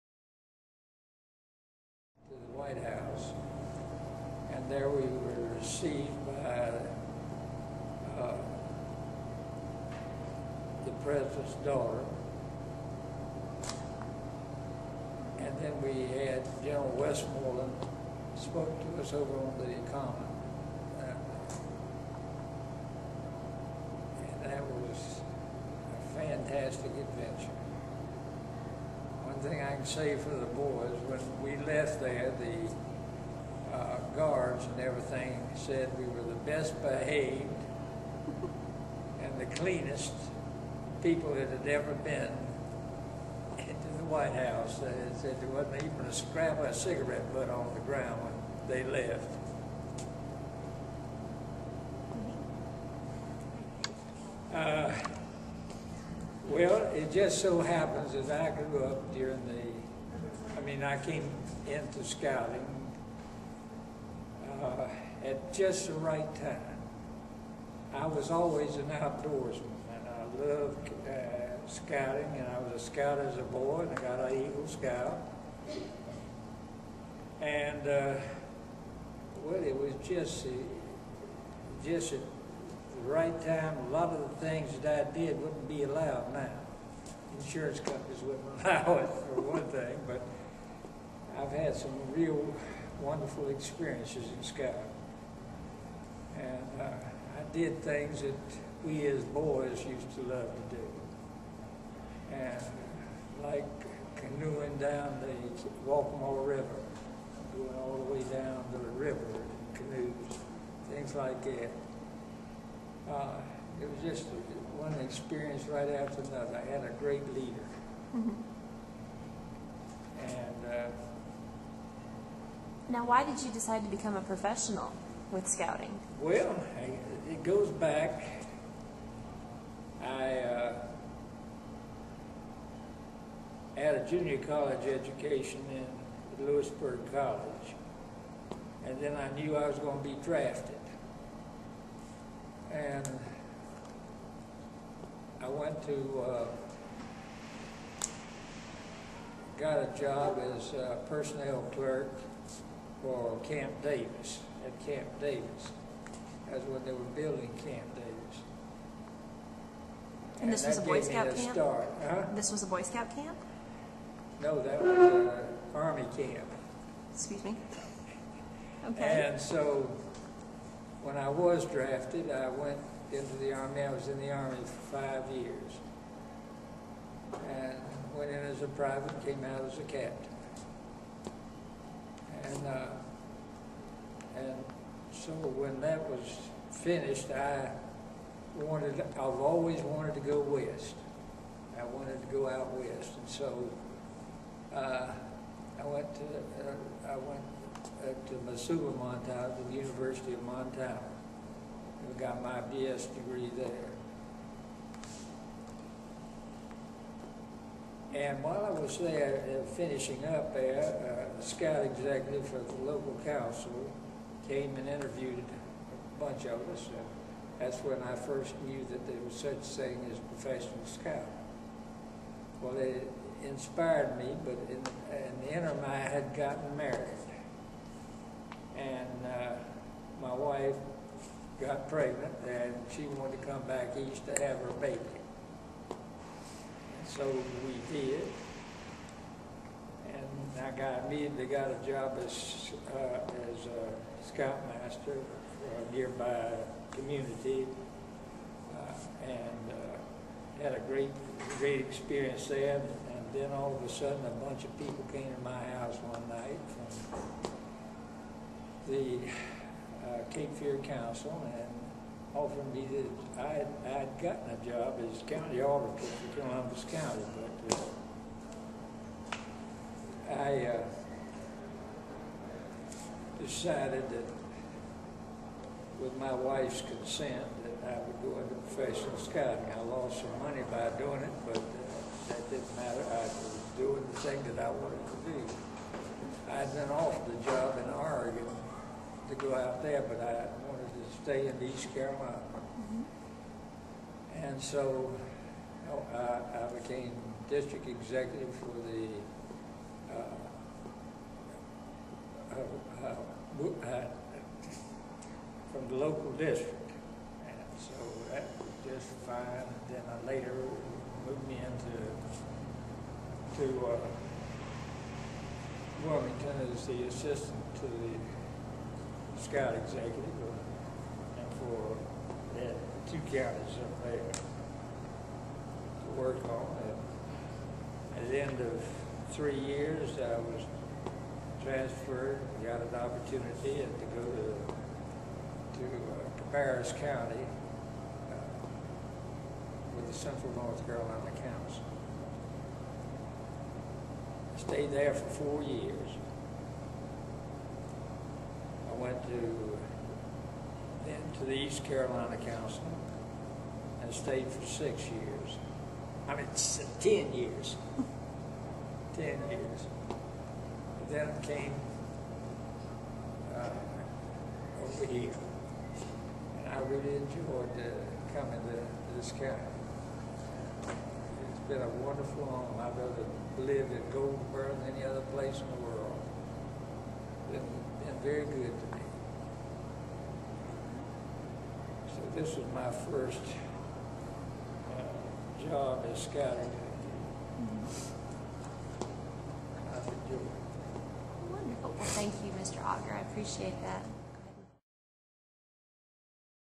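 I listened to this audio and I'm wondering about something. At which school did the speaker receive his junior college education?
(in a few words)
Louisburg College.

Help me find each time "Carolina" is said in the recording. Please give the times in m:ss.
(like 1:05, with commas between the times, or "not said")
4:51, 5:40, 5:51.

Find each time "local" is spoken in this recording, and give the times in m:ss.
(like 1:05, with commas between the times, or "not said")
3:32, 5:05.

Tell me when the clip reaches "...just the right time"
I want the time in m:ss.
1:05.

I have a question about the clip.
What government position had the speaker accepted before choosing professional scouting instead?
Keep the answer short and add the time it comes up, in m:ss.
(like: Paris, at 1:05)
county auditor, at 4:25.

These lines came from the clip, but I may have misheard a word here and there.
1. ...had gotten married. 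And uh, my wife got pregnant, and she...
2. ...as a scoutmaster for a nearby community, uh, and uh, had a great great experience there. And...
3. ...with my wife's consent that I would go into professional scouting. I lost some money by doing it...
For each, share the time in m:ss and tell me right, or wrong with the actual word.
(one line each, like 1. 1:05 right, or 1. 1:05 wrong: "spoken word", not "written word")
1. 3:45 right
2. 4:03 right
3. 4:35 right.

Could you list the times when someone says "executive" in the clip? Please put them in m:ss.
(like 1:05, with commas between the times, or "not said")
3:31, 4:57, 5:19.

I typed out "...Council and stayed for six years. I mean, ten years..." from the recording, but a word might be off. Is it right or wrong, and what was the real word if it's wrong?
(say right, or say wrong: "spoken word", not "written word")
right.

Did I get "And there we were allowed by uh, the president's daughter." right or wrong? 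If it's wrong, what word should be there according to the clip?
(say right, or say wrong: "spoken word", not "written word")
wrong: "received", not "allowed".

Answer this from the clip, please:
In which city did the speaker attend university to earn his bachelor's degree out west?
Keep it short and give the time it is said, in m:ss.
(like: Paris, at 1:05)
Missoula, Montana, at 3:18.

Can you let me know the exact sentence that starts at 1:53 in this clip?
Uh, it was just one experience right after another.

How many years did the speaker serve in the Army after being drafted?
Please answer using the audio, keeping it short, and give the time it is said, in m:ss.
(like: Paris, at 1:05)
5, at 2:54.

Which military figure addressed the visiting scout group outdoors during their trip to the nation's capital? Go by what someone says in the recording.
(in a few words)
General Westmoreland.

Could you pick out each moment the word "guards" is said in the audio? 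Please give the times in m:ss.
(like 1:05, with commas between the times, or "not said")
0:34.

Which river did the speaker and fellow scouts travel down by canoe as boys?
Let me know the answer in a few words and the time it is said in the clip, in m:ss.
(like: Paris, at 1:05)
Waccamaw River, at 1:45.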